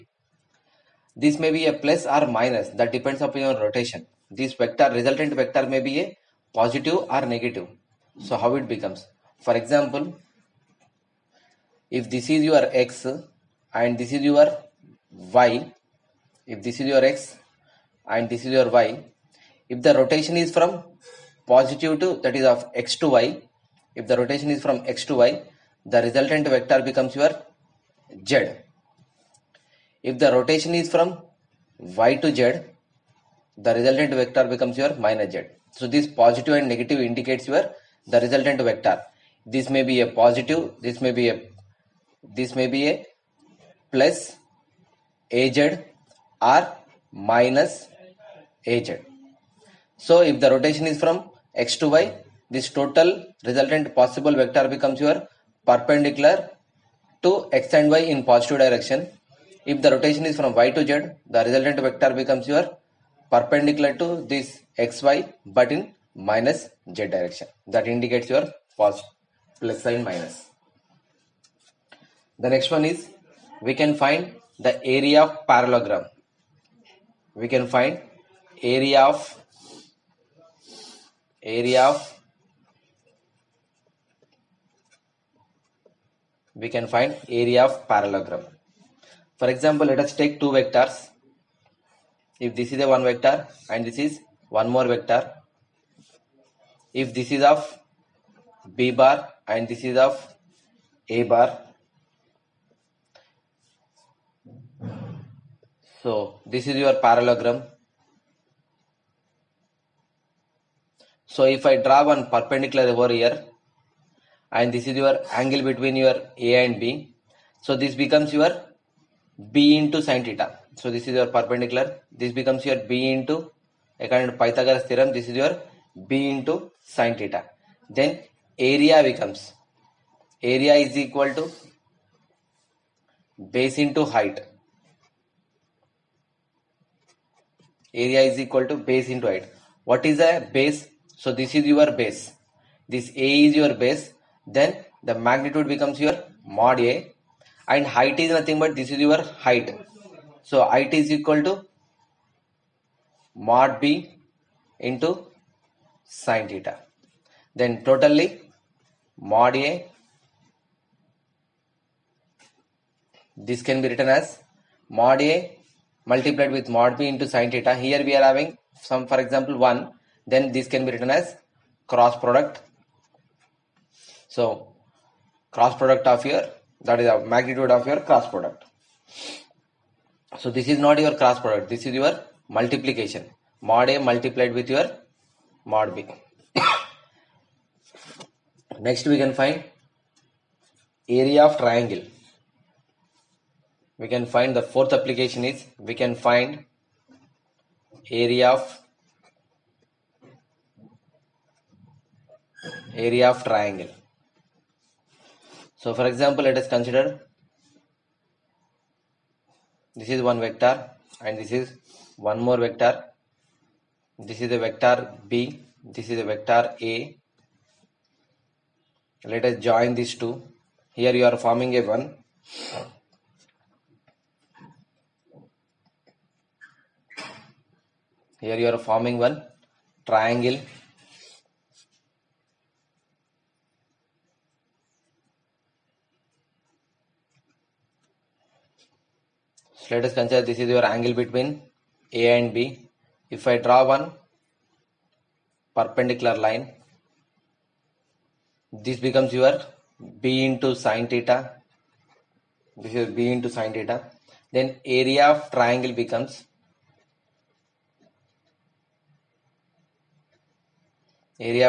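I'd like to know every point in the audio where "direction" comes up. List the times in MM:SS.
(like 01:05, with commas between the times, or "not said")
00:58, 01:07.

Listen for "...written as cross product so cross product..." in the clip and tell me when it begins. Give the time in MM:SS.
02:50.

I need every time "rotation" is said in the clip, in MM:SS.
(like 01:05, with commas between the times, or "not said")
00:03, 00:19, 00:24, 00:30, 00:50, 00:59.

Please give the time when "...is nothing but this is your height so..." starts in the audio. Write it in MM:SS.
02:28.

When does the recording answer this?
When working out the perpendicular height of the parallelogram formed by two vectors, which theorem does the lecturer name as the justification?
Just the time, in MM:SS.
02:04.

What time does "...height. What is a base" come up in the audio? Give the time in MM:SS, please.
02:19.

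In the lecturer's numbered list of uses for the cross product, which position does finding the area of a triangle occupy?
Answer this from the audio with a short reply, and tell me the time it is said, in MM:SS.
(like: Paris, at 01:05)
Fourth, at 03:14.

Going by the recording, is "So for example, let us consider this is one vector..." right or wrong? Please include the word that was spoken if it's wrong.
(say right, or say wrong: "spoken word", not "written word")
right.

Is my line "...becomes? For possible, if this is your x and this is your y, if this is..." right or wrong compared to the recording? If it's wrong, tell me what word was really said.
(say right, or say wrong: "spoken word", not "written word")
wrong: "example", not "possible".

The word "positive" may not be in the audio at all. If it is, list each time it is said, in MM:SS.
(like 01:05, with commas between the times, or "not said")
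00:06, 00:21, 00:36, 00:40, 00:58.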